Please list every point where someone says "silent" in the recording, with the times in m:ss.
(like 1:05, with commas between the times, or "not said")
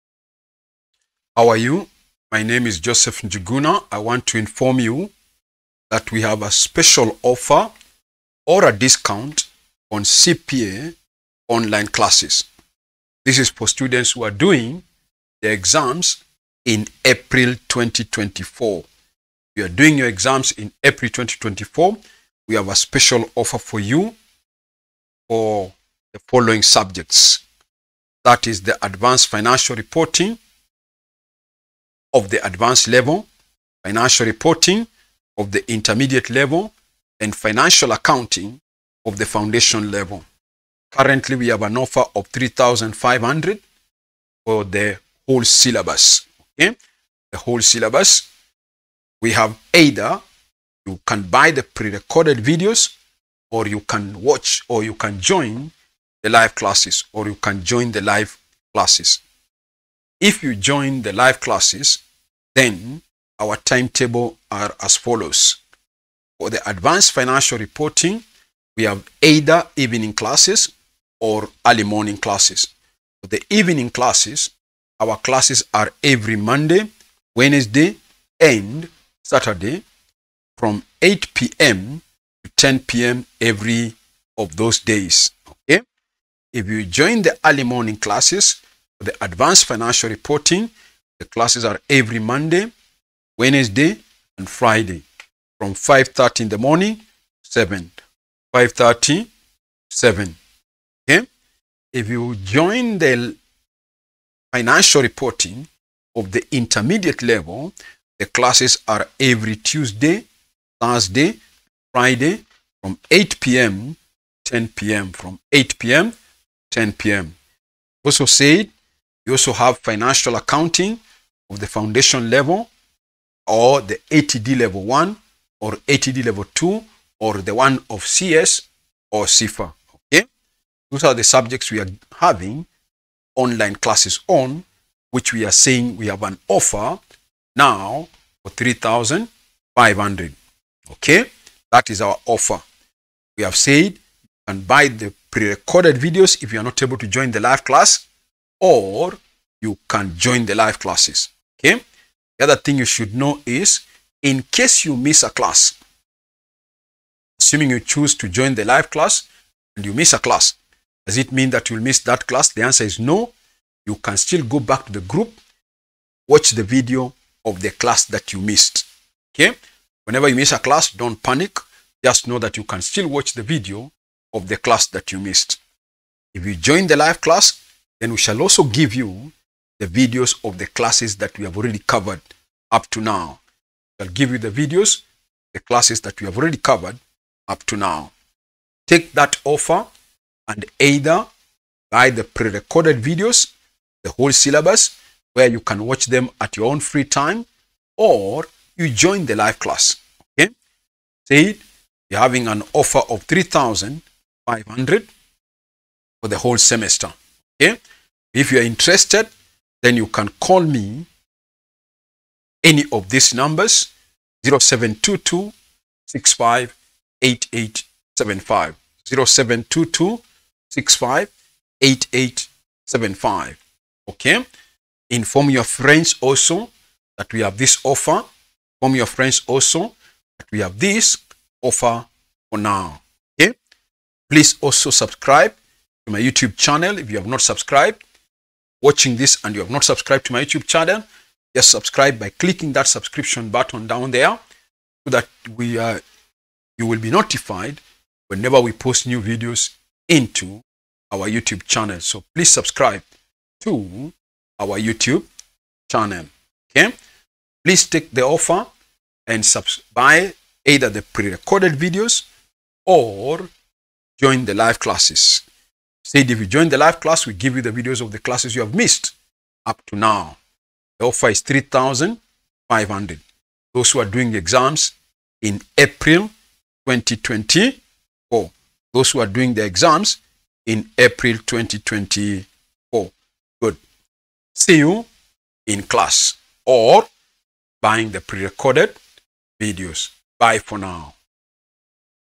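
not said.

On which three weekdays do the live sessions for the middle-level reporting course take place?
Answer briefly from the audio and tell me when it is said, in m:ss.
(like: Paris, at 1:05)
Tuesday, Thursday, Friday, at 1:49.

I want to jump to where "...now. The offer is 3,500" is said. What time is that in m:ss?
4:29.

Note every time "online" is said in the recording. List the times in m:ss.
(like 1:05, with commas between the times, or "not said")
0:11, 2:13.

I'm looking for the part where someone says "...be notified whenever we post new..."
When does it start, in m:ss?
4:06.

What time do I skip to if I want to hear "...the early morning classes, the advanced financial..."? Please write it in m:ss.
1:27.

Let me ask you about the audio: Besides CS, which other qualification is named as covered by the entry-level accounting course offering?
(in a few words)
CIFA.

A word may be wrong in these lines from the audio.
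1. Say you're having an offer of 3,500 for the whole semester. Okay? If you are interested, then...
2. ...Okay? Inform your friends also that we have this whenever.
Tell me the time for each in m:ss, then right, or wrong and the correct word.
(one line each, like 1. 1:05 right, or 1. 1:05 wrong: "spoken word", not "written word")
1. 3:21 right
2. 3:44 wrong: "offer", not "whenever".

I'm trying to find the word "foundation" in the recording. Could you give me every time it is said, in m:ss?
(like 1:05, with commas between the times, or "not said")
0:39, 2:01.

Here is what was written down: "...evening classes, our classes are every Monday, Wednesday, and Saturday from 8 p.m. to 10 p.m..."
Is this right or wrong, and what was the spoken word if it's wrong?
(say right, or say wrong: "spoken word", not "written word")
right.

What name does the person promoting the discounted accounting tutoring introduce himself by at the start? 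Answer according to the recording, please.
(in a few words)
Joseph Njuguna.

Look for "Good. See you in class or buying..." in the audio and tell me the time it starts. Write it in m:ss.
4:43.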